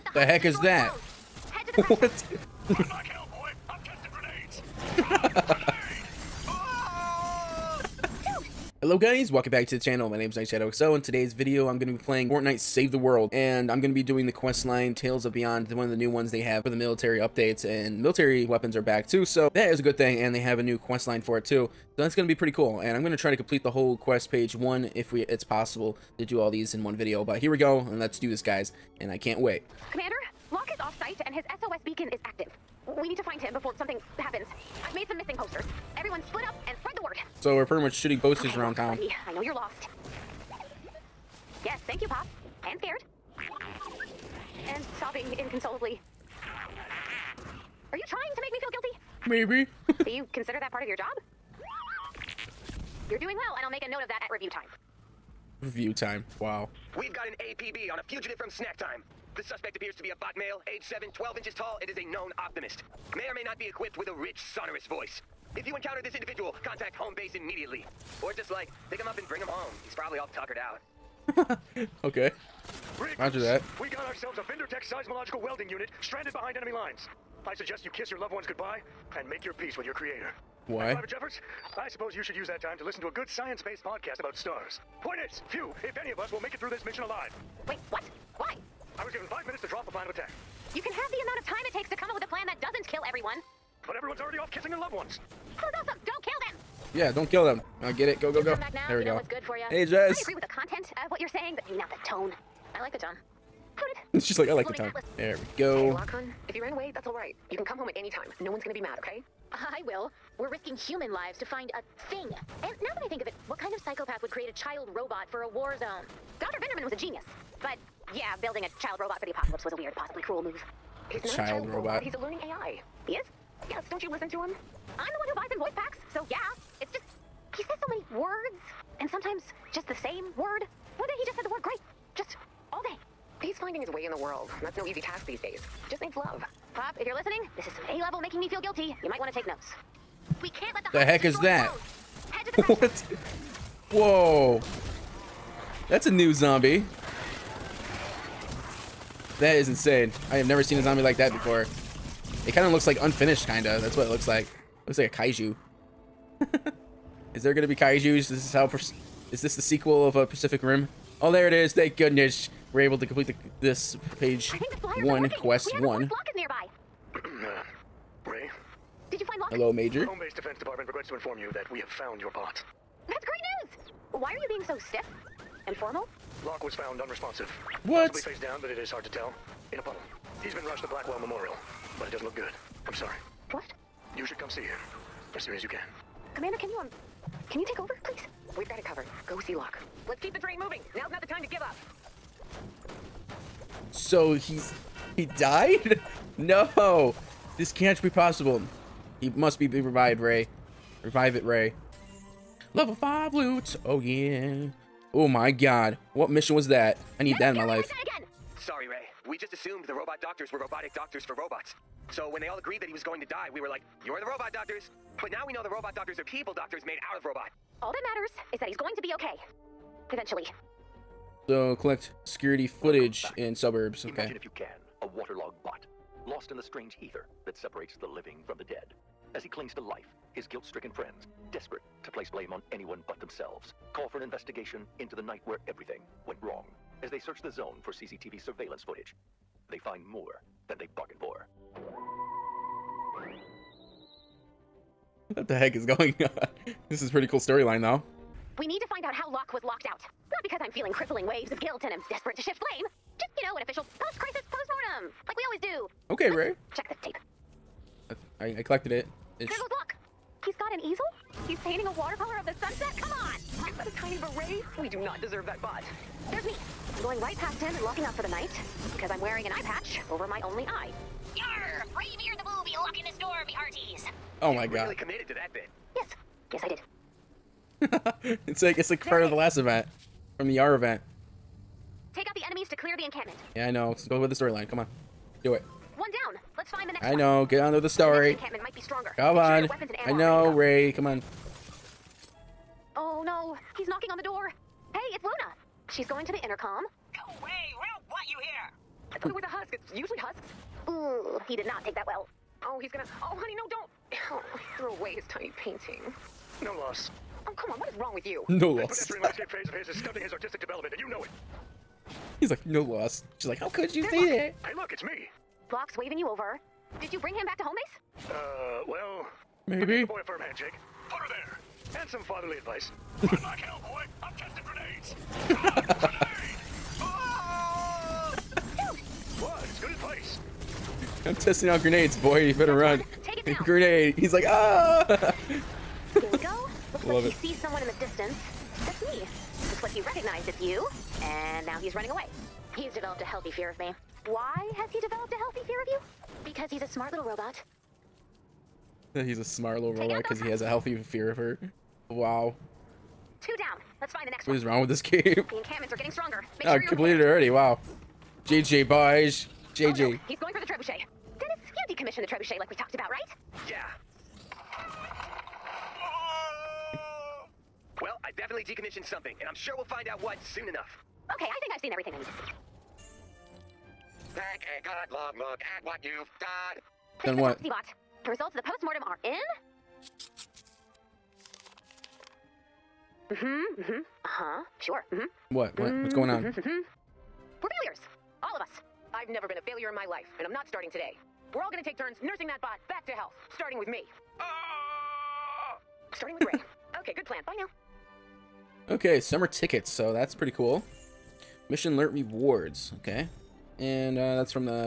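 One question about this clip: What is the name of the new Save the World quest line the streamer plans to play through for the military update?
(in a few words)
Tales of Beyond.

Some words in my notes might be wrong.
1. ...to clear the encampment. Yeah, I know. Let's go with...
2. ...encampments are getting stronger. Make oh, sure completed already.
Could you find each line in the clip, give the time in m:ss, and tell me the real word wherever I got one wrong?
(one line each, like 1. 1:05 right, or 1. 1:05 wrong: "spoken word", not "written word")
1. 4:42 right
2. 5:55 right.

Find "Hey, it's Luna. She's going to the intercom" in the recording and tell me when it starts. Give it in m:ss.
4:54.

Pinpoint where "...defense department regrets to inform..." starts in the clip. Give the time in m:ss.
2:50.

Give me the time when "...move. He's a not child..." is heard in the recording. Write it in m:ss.
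2:00.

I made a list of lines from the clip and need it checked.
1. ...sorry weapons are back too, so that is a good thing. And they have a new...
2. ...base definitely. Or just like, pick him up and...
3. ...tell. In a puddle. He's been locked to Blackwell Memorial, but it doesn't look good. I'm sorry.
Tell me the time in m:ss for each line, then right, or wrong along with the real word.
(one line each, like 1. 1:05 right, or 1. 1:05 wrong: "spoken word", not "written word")
1. 0:18 wrong: "military", not "sorry"
2. 1:07 wrong: "immediately", not "definitely"
3. 2:59 wrong: "rushed", not "locked".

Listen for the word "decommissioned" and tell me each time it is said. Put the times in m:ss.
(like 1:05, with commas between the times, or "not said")
6:01, 6:08.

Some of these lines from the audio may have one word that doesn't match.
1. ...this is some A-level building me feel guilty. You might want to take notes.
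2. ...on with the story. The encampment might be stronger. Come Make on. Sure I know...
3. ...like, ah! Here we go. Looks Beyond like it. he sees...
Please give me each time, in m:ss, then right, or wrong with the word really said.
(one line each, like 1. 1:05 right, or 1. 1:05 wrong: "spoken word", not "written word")
1. 2:17 wrong: "making", not "building"
2. 4:47 right
3. 5:34 wrong: "Love", not "Beyond".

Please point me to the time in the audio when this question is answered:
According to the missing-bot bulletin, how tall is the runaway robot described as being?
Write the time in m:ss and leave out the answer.
1:01.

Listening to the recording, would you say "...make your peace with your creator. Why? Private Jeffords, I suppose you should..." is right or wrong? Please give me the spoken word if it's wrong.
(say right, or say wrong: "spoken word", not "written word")
right.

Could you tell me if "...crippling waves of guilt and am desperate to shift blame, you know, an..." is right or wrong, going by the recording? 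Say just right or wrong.
right.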